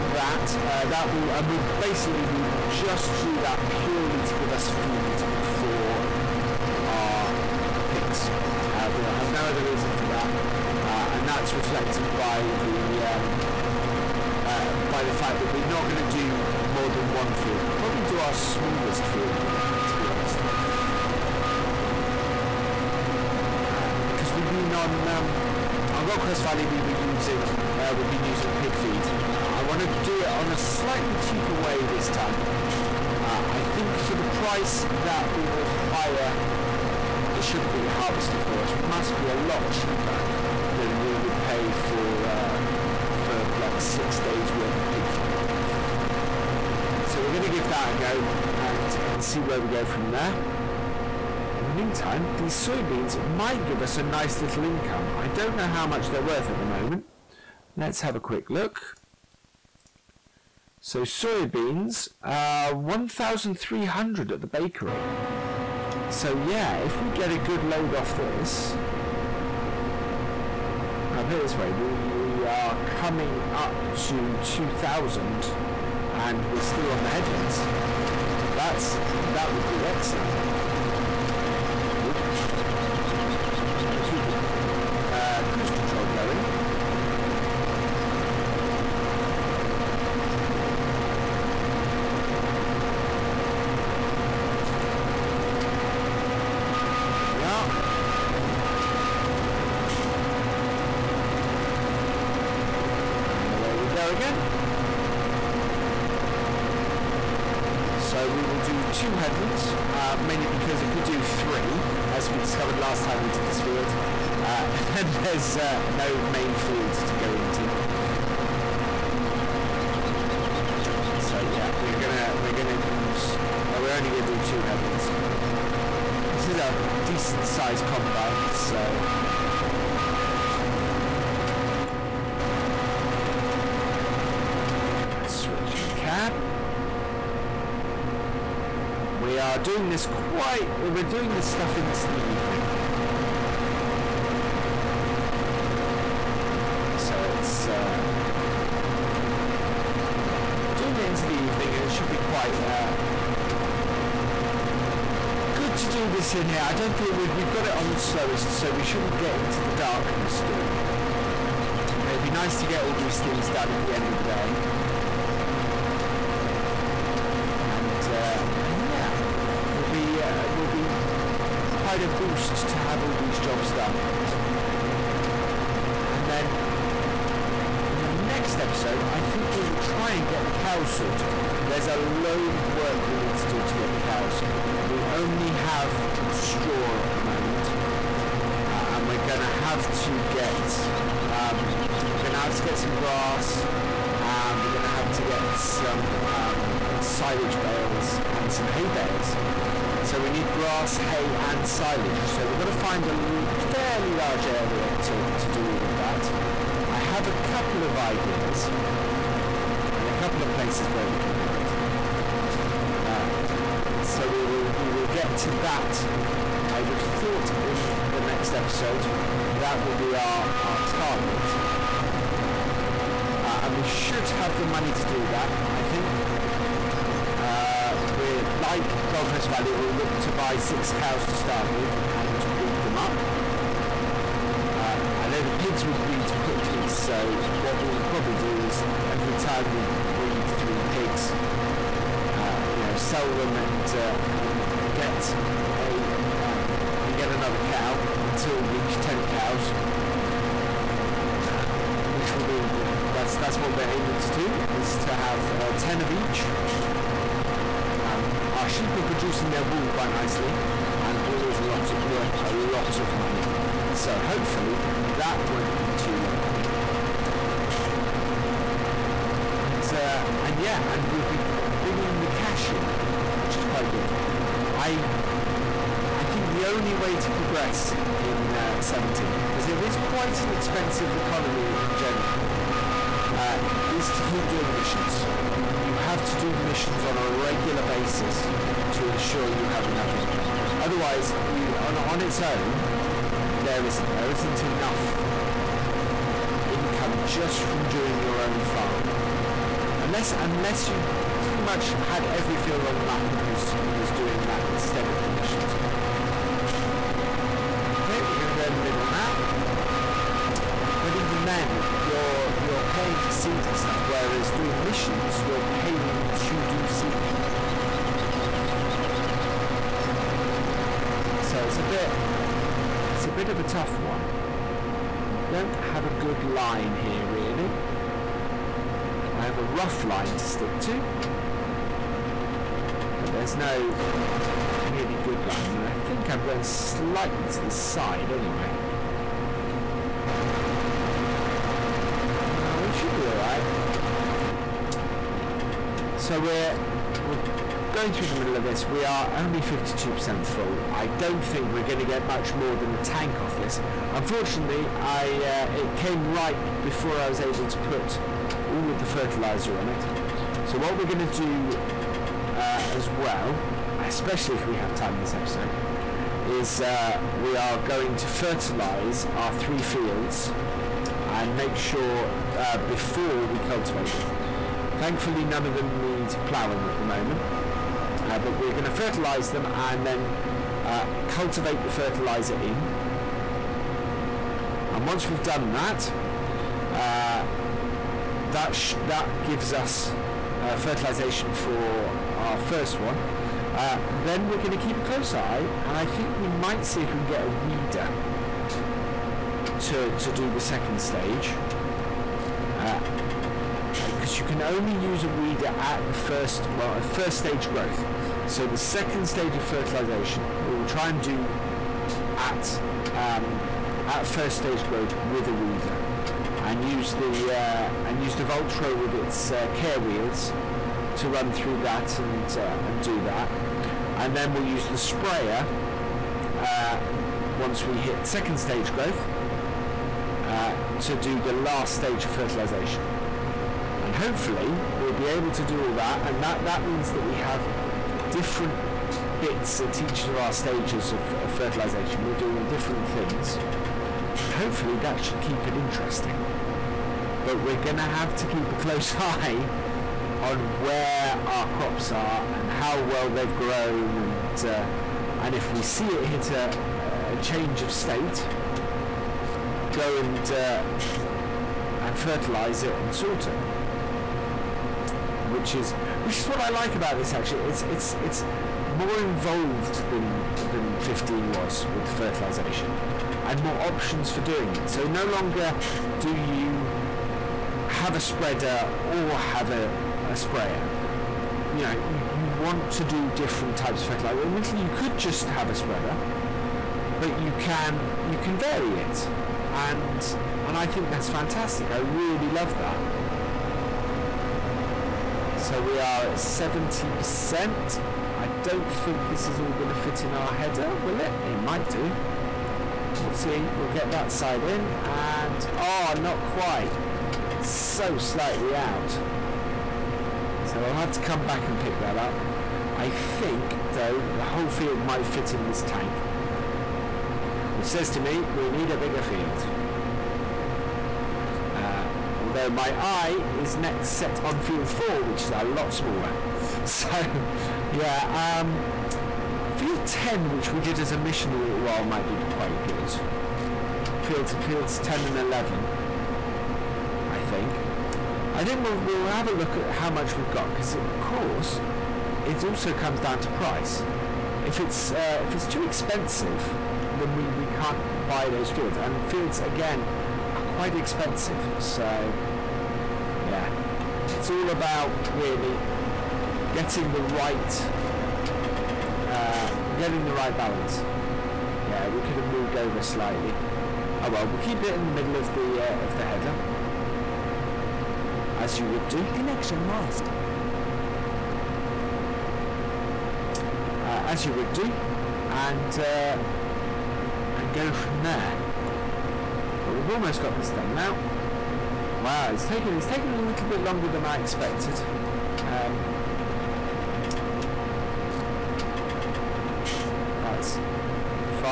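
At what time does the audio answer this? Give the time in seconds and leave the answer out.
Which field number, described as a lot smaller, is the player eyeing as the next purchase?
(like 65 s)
524 s.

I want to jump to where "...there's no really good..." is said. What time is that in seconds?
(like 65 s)
333 s.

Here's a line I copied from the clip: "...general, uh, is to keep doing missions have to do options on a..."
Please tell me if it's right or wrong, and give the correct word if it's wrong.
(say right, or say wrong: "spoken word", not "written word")
wrong: "missions", not "options".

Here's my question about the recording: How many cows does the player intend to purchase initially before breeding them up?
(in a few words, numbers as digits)
6.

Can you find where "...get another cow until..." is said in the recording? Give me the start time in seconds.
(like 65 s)
247 s.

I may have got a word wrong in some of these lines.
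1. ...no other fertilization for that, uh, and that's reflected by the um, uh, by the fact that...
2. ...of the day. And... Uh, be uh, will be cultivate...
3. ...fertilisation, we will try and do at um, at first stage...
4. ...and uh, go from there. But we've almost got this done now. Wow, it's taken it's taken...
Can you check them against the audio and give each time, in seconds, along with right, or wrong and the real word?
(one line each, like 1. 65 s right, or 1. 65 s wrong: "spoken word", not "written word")
1. 9 s wrong: "reason", not "fertilization"
2. 167 s wrong: "quite", not "cultivate"
3. 409 s right
4. 575 s right.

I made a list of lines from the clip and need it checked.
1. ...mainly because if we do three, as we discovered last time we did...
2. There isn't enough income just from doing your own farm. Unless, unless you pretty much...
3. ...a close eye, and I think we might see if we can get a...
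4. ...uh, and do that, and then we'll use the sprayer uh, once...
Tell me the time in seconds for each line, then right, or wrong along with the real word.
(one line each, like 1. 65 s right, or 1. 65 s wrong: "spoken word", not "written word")
1. 110 s right
2. 294 s right
3. 394 s right
4. 422 s right.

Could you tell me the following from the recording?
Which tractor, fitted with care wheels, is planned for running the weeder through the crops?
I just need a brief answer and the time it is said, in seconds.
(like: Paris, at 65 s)
Valtra, at 418 s.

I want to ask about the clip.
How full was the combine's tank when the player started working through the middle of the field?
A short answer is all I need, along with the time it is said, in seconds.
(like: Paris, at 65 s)
52%, at 349 s.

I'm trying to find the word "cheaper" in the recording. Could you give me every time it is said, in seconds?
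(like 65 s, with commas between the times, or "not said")
31 s, 39 s.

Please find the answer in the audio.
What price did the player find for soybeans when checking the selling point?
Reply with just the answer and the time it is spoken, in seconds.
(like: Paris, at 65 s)
1,300, at 62 s.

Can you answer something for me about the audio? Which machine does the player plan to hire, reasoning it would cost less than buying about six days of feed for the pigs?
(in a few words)
Sugar beet harvester.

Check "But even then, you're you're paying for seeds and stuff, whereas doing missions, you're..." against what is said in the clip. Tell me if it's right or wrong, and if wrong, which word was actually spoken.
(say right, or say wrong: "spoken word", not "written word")
right.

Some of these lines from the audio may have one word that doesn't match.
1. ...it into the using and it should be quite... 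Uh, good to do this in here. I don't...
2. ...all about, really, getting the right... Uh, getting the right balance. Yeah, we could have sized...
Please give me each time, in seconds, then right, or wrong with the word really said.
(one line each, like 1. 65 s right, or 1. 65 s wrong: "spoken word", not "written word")
1. 150 s wrong: "evening", not "using"
2. 554 s wrong: "moved", not "sized".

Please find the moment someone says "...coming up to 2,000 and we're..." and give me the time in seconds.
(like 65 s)
72 s.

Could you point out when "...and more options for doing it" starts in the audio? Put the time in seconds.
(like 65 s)
473 s.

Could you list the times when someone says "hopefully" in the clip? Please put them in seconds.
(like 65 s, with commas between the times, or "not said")
264 s, 434 s, 444 s.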